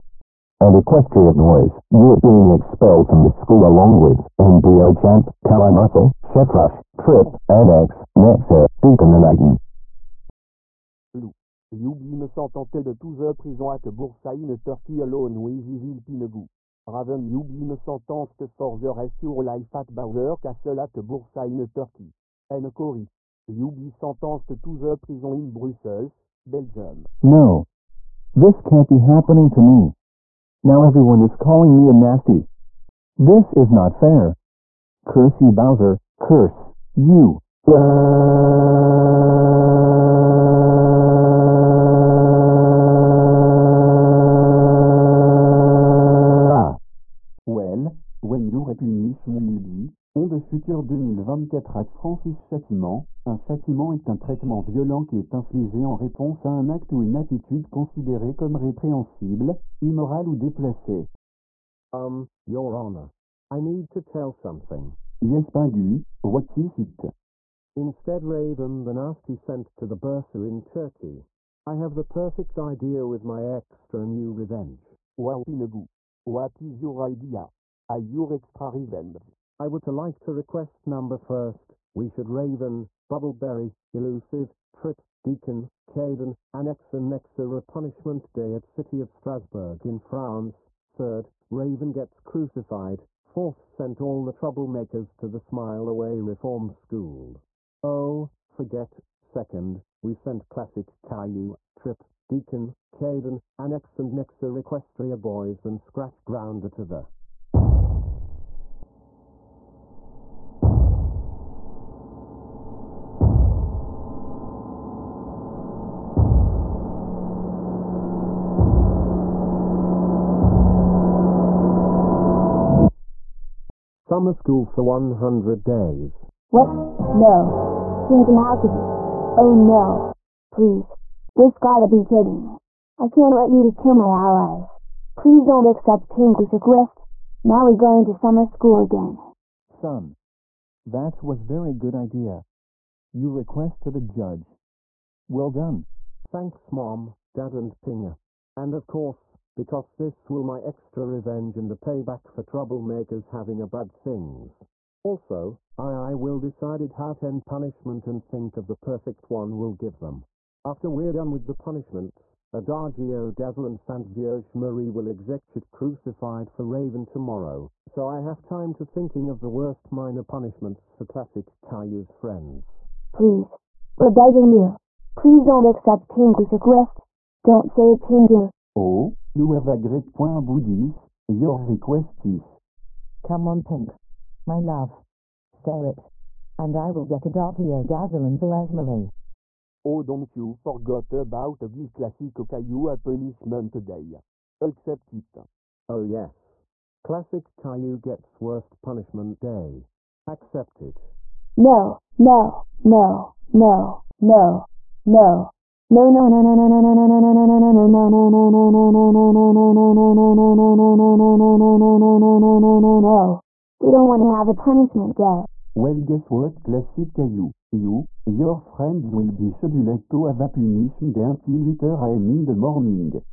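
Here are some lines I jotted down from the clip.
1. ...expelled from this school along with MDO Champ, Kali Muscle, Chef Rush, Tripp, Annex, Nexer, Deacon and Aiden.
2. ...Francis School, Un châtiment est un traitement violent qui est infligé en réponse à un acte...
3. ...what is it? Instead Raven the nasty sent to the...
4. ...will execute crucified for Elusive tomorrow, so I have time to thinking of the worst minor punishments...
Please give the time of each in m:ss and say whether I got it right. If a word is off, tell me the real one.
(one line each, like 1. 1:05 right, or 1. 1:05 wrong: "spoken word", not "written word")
1. 0:02 right
2. 0:51 wrong: "Châtiment", not "School"
3. 1:06 right
4. 2:44 wrong: "Raven", not "Elusive".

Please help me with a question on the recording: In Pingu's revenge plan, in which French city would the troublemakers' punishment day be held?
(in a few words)
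Strasbourg.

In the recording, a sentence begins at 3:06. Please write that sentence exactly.
And I will get Adagio Dazzle and Vierge Marie.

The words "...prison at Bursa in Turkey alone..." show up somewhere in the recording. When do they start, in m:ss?
0:13.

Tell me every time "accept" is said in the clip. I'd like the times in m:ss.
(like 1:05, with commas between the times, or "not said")
2:15, 2:55, 3:14, 3:20.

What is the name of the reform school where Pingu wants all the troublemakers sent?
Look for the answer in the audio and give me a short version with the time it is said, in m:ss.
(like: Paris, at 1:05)
Smile Away Reform School, at 1:35.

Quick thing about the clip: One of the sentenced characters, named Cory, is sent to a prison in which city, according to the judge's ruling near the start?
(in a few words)
Brussels.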